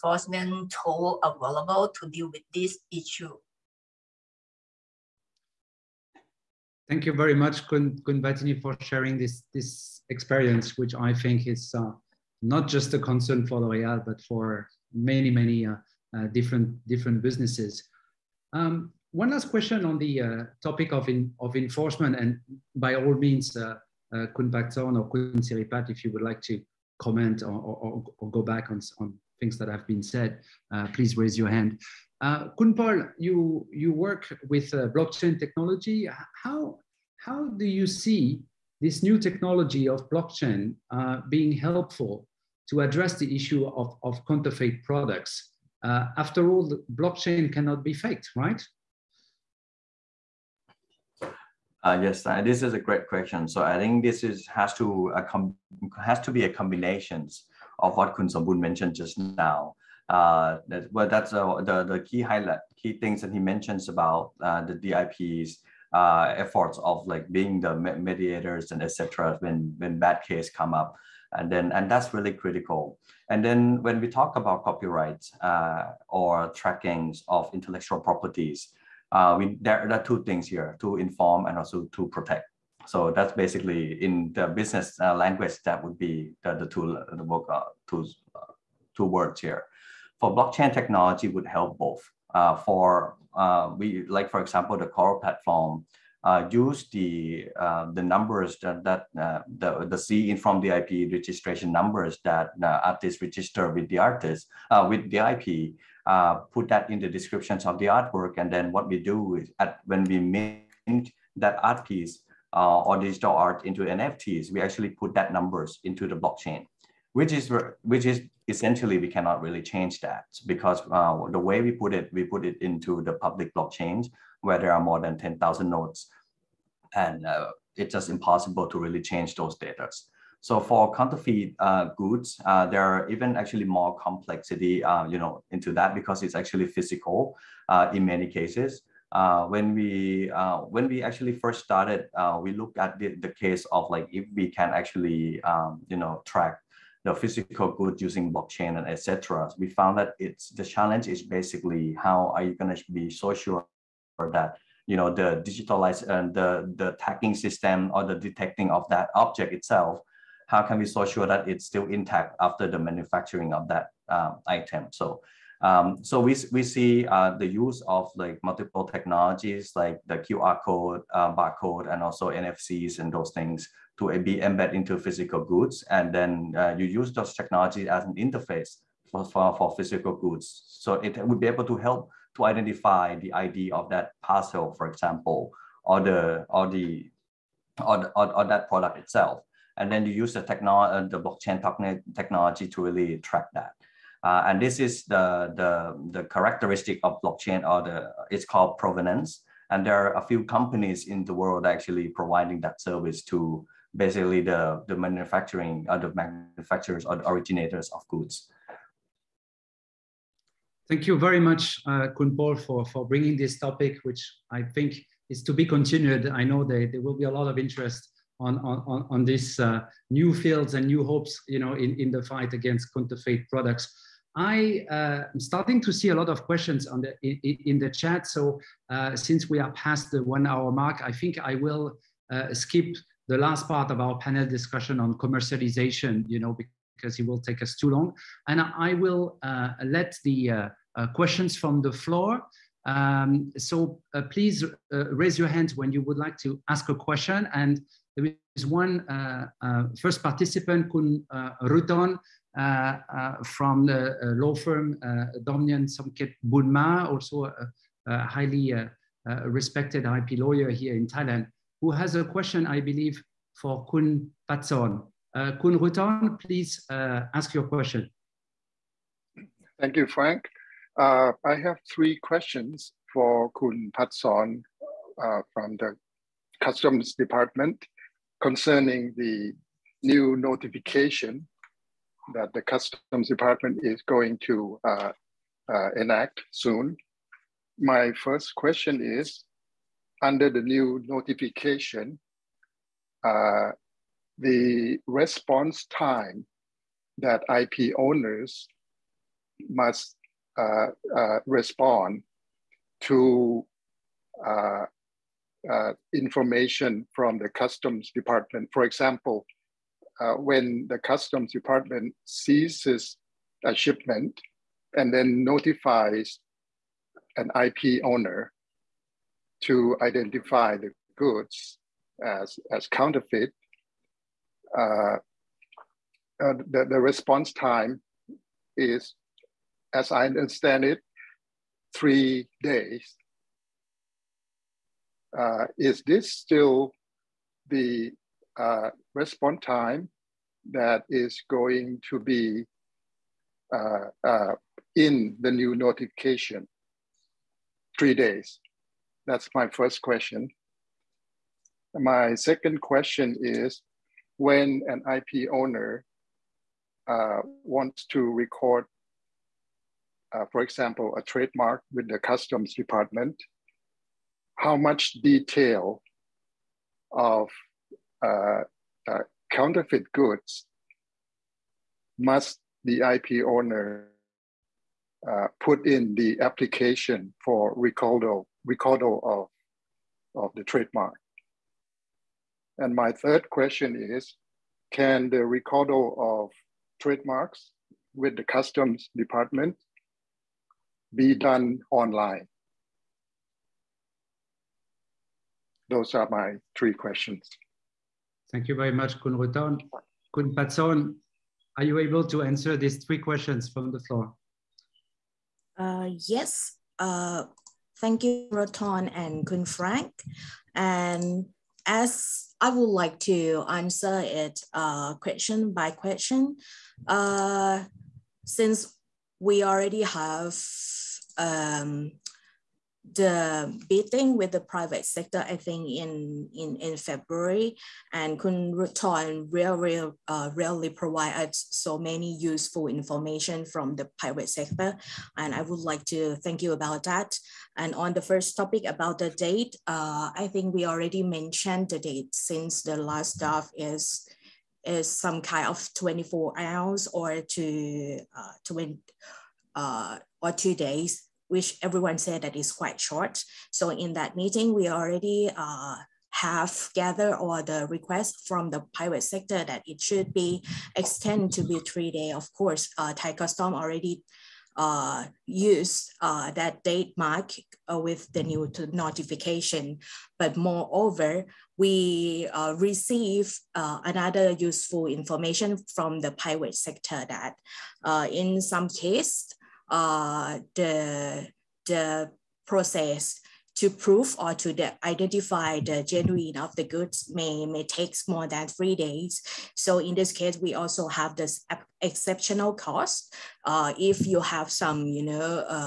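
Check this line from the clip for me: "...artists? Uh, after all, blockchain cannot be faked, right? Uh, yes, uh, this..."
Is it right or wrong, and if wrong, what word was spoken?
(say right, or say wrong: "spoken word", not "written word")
wrong: "products", not "artists".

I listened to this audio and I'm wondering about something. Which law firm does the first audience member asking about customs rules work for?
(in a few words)
Domnern Somgiat Boonma.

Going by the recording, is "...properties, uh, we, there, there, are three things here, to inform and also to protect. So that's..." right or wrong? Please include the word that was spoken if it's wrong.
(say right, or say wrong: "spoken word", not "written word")
wrong: "two", not "three".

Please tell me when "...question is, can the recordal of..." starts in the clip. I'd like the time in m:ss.
6:23.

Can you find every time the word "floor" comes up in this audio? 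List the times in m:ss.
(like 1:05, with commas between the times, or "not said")
4:01, 6:44.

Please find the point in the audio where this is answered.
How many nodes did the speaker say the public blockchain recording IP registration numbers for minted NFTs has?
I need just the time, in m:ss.
2:04.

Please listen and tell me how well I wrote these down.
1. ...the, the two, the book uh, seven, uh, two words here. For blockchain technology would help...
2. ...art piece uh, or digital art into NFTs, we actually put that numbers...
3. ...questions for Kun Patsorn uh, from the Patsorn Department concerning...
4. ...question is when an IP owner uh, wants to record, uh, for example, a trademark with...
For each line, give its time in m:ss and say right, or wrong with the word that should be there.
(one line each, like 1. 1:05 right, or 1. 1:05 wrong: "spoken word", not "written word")
1. 1:26 wrong: "two", not "seven"
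2. 1:51 right
3. 4:32 wrong: "Customs", not "Patsorn"
4. 5:52 right.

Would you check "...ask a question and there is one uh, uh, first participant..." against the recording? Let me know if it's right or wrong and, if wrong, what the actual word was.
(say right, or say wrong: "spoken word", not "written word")
right.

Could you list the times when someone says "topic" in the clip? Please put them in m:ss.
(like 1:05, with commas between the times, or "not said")
0:20, 3:33, 7:18.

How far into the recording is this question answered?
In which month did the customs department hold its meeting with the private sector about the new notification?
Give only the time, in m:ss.
7:06.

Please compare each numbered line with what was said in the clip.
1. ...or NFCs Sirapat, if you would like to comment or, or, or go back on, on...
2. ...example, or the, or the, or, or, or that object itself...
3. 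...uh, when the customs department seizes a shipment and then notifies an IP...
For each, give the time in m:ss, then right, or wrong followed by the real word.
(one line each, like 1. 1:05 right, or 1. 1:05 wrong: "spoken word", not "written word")
1. 0:24 wrong: "Kun", not "NFCs"
2. 3:04 wrong: "product", not "object"
3. 5:10 right.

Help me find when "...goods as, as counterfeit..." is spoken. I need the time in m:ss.
5:21.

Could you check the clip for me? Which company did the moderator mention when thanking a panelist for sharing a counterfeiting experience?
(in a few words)
L'Oreal.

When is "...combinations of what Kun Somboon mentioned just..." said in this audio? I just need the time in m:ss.
0:56.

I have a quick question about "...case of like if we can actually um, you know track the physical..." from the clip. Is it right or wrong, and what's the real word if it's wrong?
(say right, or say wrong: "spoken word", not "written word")
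right.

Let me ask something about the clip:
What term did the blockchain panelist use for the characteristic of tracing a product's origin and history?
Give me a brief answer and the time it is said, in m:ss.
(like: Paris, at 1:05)
provenance, at 3:18.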